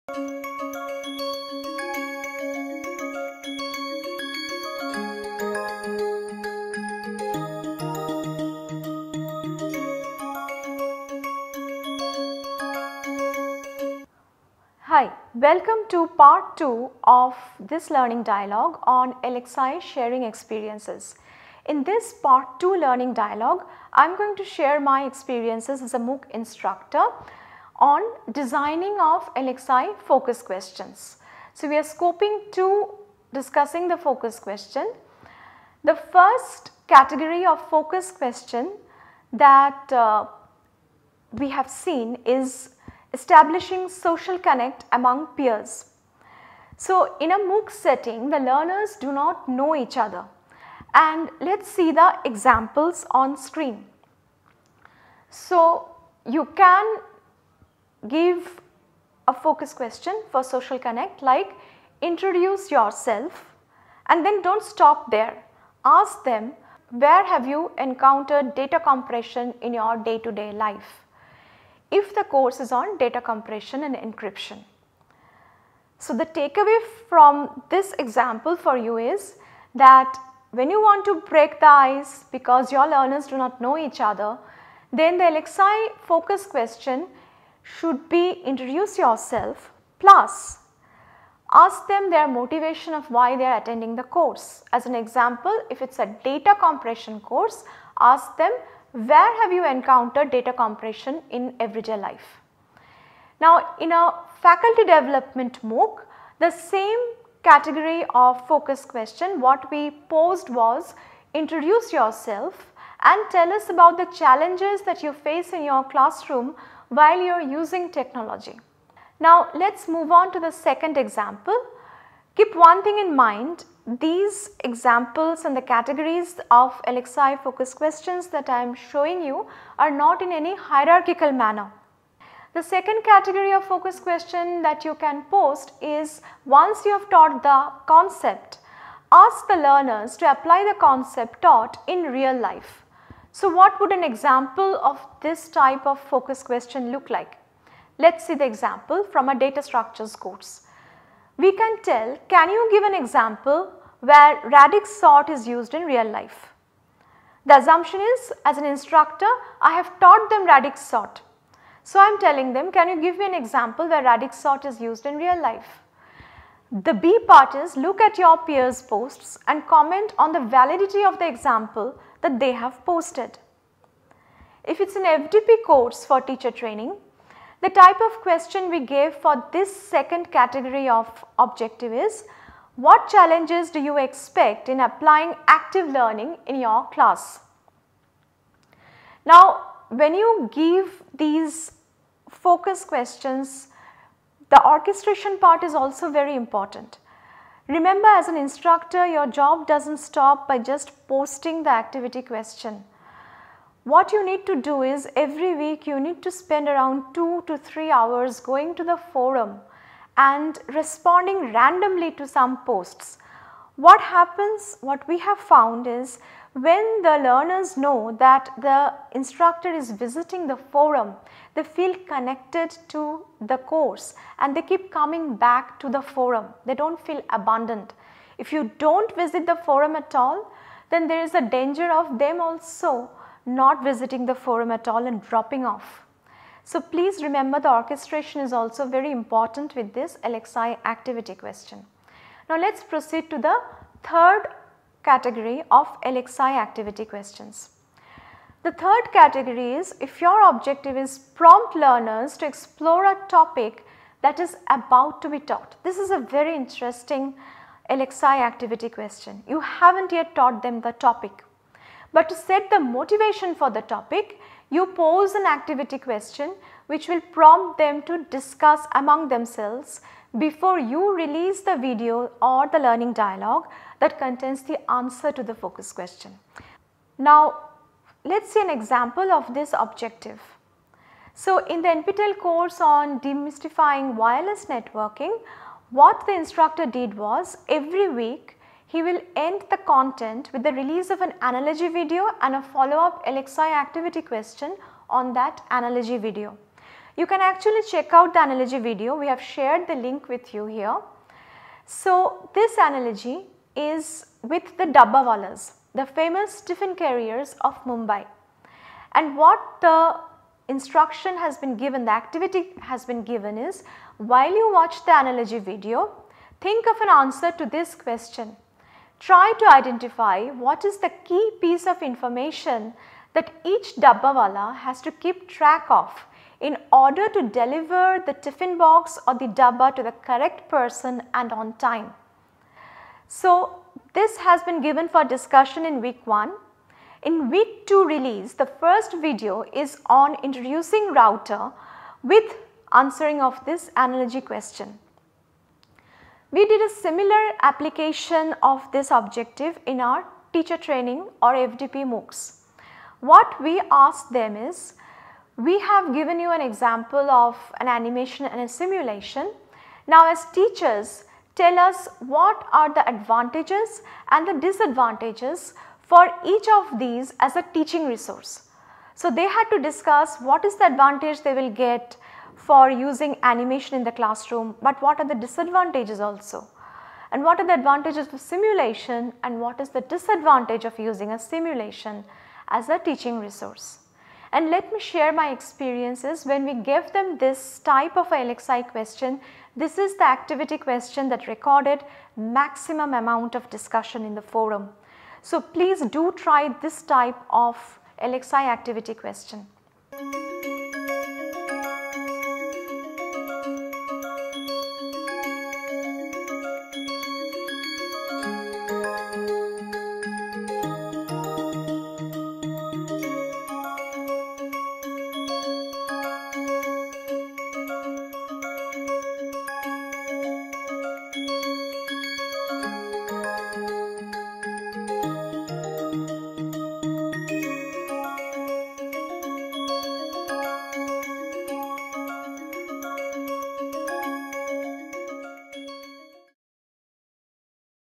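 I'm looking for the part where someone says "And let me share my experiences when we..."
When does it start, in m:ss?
6:24.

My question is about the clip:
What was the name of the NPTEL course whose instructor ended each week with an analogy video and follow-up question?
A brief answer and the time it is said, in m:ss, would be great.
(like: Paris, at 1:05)
demystifying wireless networking, at 4:43.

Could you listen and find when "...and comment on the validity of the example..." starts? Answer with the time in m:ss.
2:49.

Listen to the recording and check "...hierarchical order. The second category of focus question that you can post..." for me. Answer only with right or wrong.
wrong.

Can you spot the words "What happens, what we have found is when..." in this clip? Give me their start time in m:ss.
3:33.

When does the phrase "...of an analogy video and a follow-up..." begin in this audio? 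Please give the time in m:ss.
4:51.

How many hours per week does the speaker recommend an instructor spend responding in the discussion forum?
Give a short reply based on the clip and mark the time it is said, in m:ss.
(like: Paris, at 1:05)
2 to 3 hours, at 3:27.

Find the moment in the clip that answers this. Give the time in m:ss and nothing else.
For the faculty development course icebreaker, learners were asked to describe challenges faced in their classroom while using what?
1:57.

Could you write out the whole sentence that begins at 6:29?
This is the activity question that recorded maximum amount of discussion in the forum.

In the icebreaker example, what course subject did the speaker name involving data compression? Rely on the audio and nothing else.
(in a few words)
data compression and encryption.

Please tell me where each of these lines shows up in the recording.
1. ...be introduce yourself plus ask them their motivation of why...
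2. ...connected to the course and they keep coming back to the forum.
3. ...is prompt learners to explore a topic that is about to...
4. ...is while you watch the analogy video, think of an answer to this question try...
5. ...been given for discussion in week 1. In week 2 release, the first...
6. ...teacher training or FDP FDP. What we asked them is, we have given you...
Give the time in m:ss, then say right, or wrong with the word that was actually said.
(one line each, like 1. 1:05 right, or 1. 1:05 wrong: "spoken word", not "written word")
1. 1:28 right
2. 3:42 right
3. 4:10 right
4. 5:13 right
5. 5:34 right
6. 5:50 wrong: "MOOCs", not "FDP".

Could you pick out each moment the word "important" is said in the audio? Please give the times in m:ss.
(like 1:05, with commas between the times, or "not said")
3:16, 3:59.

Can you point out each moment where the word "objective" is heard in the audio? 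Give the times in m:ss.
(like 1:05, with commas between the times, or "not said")
3:01, 4:10, 4:39, 5:49.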